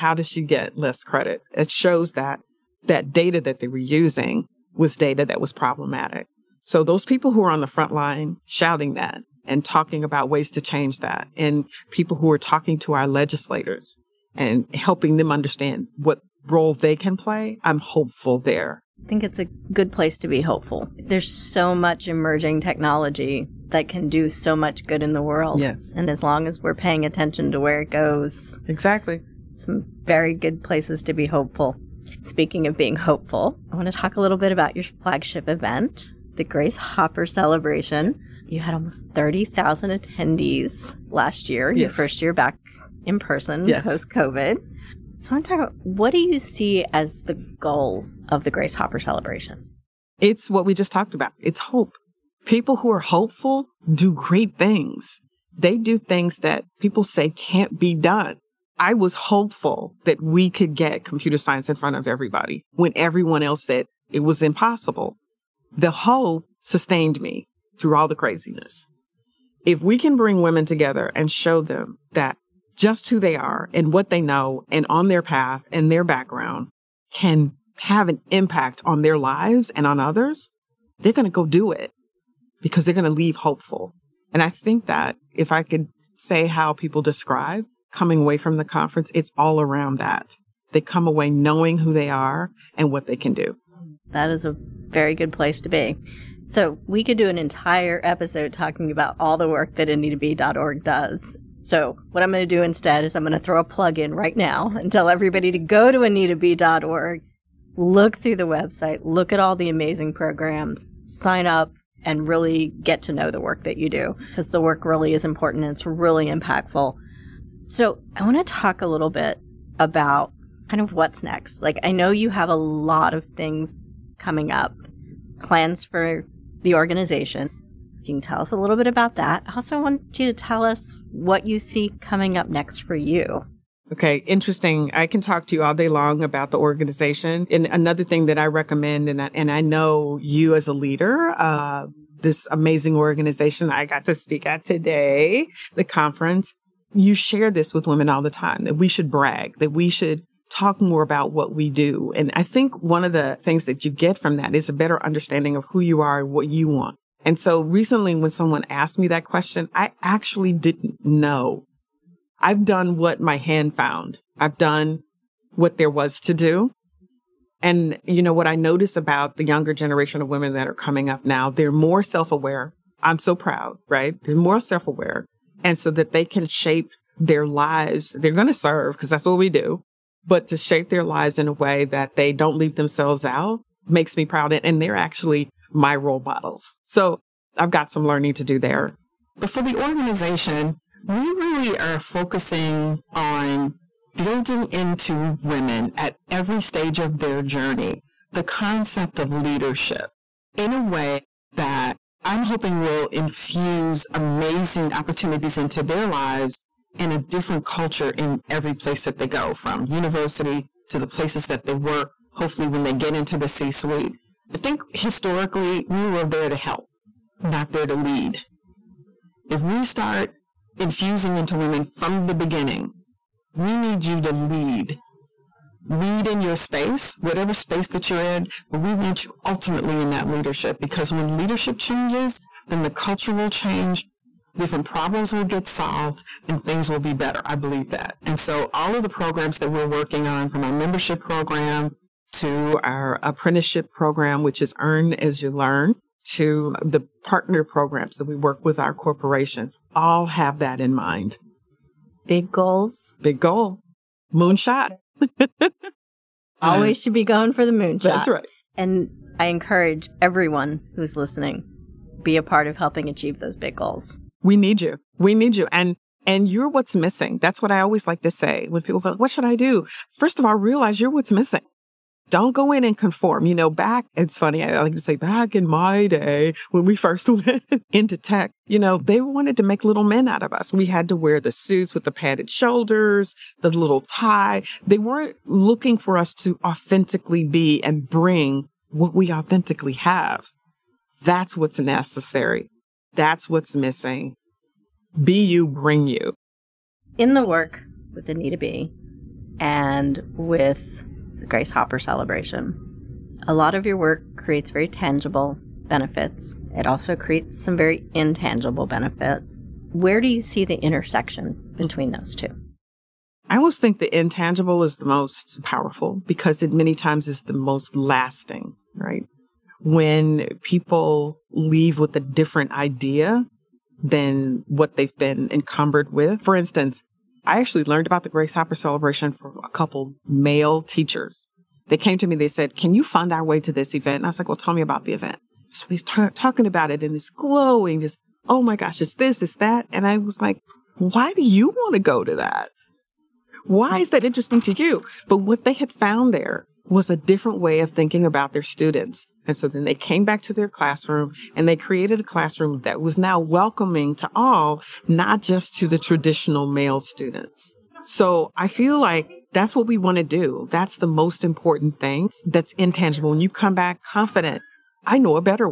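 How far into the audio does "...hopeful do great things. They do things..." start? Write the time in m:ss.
0:52.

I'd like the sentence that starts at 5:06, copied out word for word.
It also creates some very intangible benefits.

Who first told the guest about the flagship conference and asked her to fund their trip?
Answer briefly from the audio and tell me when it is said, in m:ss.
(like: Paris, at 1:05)
a couple male teachers, at 5:29.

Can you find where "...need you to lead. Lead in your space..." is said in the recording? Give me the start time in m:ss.
3:43.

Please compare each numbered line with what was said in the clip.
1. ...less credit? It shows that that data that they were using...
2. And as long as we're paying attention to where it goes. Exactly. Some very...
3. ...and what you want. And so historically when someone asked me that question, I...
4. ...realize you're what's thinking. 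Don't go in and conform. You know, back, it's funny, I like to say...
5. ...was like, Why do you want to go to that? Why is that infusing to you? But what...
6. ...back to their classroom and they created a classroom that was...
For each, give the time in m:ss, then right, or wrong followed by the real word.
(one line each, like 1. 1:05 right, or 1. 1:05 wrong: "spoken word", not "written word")
1. 0:00 right
2. 0:25 right
3. 2:36 wrong: "recently", not "historically"
4. 4:30 wrong: "missing", not "thinking"
5. 5:40 wrong: "interesting", not "infusing"
6. 5:50 right.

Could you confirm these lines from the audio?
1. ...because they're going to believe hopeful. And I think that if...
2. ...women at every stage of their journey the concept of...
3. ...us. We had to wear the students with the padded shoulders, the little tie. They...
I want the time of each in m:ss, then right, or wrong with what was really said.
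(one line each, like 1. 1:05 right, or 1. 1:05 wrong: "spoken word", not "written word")
1. 1:22 wrong: "leave", not "believe"
2. 3:15 right
3. 4:40 wrong: "suits", not "students".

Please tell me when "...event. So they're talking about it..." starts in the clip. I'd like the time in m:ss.
5:35.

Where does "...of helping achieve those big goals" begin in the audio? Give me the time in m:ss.
4:22.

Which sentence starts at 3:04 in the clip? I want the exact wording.
And they're actually my role models.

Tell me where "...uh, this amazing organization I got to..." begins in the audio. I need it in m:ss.
2:21.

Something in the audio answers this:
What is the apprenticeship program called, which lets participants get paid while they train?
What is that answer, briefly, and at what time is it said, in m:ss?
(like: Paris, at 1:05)
Earn as You Learn, at 4:04.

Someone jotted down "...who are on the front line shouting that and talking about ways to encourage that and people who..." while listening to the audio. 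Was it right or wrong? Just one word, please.
wrong.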